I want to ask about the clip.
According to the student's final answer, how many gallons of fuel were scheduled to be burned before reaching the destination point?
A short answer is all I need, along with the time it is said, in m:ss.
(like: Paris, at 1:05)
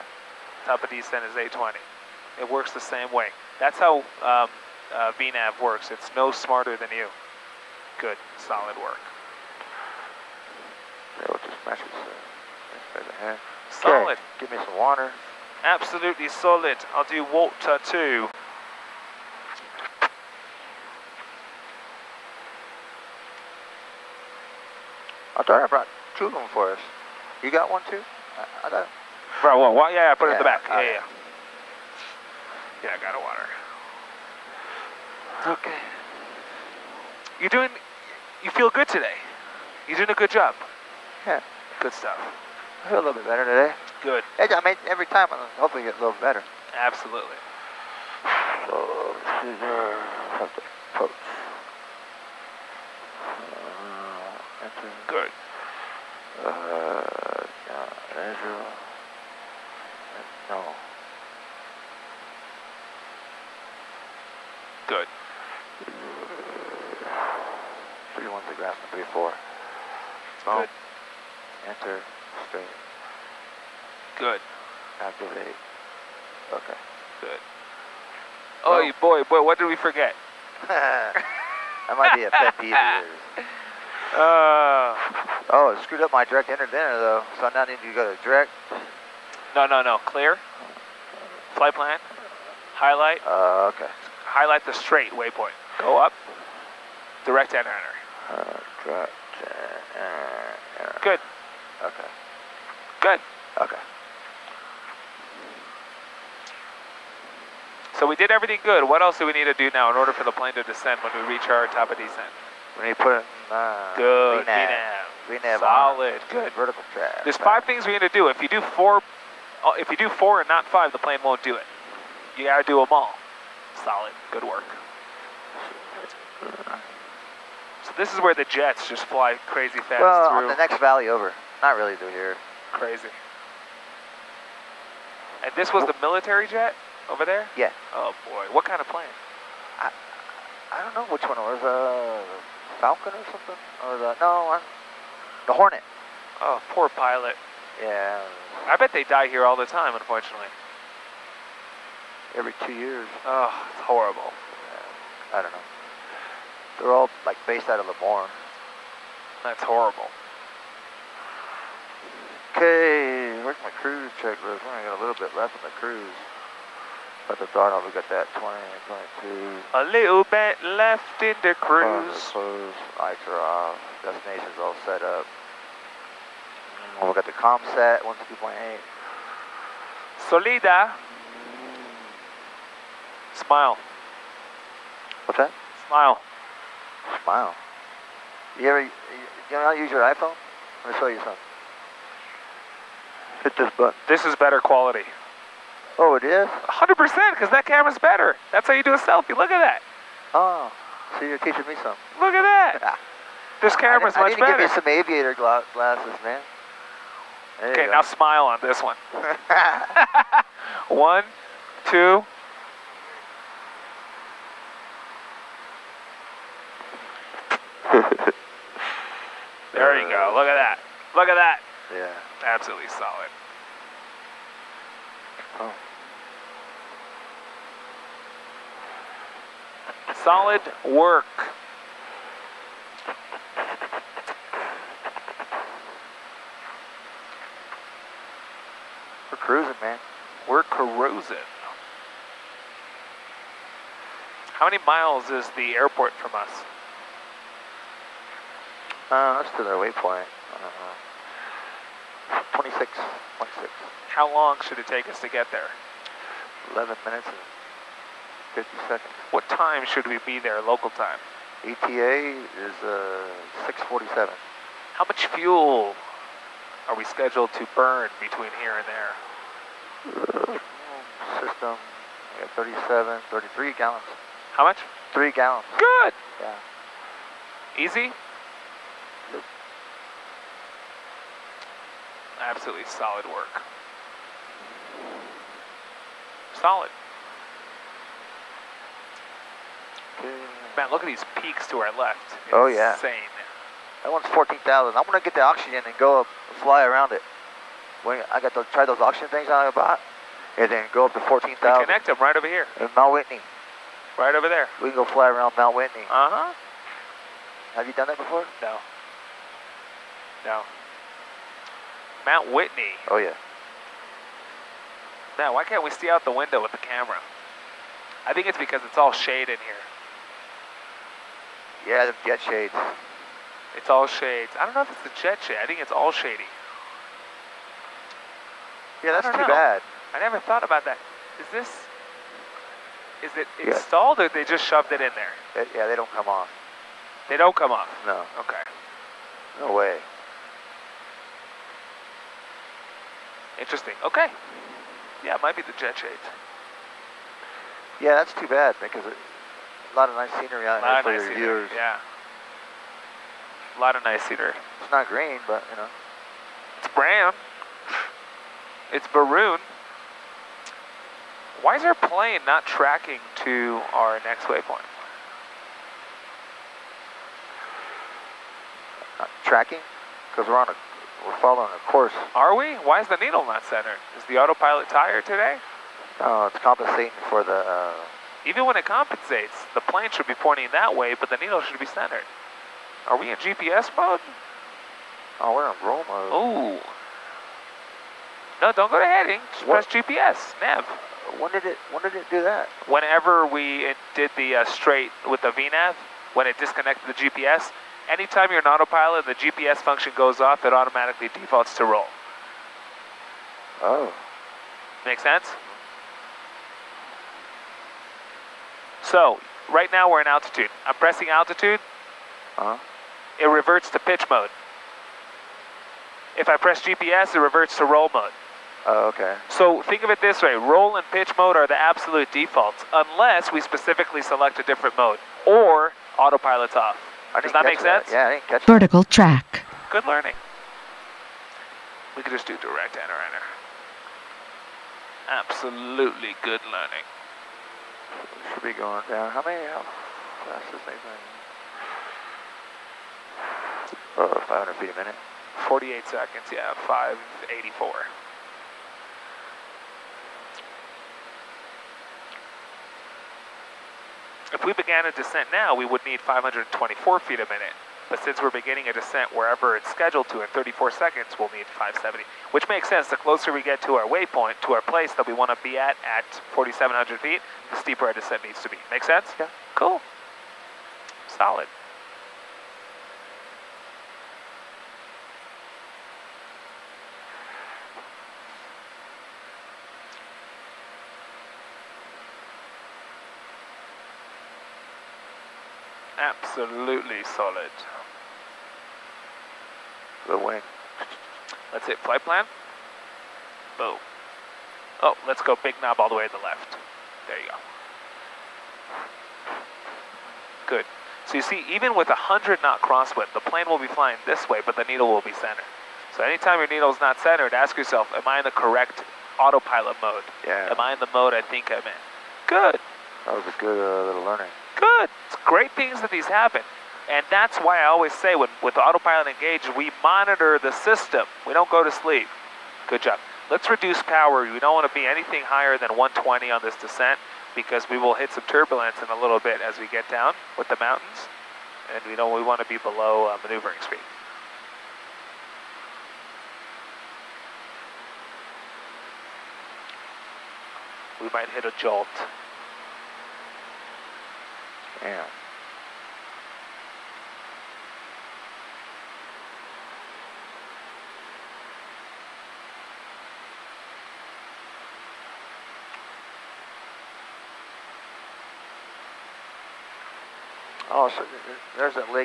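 3 gallons, at 4:35.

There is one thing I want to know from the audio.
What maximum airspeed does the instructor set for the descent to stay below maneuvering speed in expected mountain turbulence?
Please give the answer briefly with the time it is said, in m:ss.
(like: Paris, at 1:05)
120, at 8:45.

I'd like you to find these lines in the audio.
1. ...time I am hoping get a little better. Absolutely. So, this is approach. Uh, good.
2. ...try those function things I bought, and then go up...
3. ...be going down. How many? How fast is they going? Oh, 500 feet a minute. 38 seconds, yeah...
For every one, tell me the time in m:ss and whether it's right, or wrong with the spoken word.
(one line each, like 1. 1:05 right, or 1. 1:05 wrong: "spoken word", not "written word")
1. 0:45 right
2. 4:58 wrong: "auction", not "function"
3. 7:18 wrong: "48", not "38".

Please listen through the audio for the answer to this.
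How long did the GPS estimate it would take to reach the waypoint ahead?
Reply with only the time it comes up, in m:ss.
4:16.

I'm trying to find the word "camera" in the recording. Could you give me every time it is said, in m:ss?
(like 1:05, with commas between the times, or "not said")
3:17, 3:23, 5:16.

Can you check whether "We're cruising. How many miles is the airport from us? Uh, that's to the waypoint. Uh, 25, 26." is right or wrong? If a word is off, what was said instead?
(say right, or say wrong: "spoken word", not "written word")
wrong: "26", not "25".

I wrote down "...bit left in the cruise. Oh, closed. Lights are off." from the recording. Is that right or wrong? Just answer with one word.
right.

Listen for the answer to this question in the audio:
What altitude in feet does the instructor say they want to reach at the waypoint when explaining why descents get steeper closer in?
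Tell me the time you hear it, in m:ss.
7:46.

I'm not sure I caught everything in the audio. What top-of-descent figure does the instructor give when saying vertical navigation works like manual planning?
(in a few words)
820.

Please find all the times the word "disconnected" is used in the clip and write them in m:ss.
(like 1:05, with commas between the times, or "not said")
6:36.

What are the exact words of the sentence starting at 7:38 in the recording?
But since we're beginning a descent wherever it's scheduled to in 34 seconds, we'll need 570, which makes sense.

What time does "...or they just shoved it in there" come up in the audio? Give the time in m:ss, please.
5:34.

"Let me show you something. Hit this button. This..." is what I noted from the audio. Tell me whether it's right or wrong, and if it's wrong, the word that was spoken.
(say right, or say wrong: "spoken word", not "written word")
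right.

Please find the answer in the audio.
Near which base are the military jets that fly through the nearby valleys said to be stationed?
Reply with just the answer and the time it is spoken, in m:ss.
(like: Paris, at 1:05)
Lemoore, at 2:37.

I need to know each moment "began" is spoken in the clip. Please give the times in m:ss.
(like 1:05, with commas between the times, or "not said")
7:34.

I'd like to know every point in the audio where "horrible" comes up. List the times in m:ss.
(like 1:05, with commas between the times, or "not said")
2:33, 2:39.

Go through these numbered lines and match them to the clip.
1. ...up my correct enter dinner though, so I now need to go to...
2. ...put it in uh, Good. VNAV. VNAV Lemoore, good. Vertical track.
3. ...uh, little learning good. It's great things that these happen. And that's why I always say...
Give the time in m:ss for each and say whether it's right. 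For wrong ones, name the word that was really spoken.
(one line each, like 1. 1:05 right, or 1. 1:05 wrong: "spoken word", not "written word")
1. 1:26 wrong: "direct", not "correct"
2. 1:53 wrong: "Solid", not "Lemoore"
3. 8:33 right.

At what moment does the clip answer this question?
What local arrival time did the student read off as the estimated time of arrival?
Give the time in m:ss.
4:23.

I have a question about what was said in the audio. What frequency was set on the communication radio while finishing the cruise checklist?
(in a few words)
152.8.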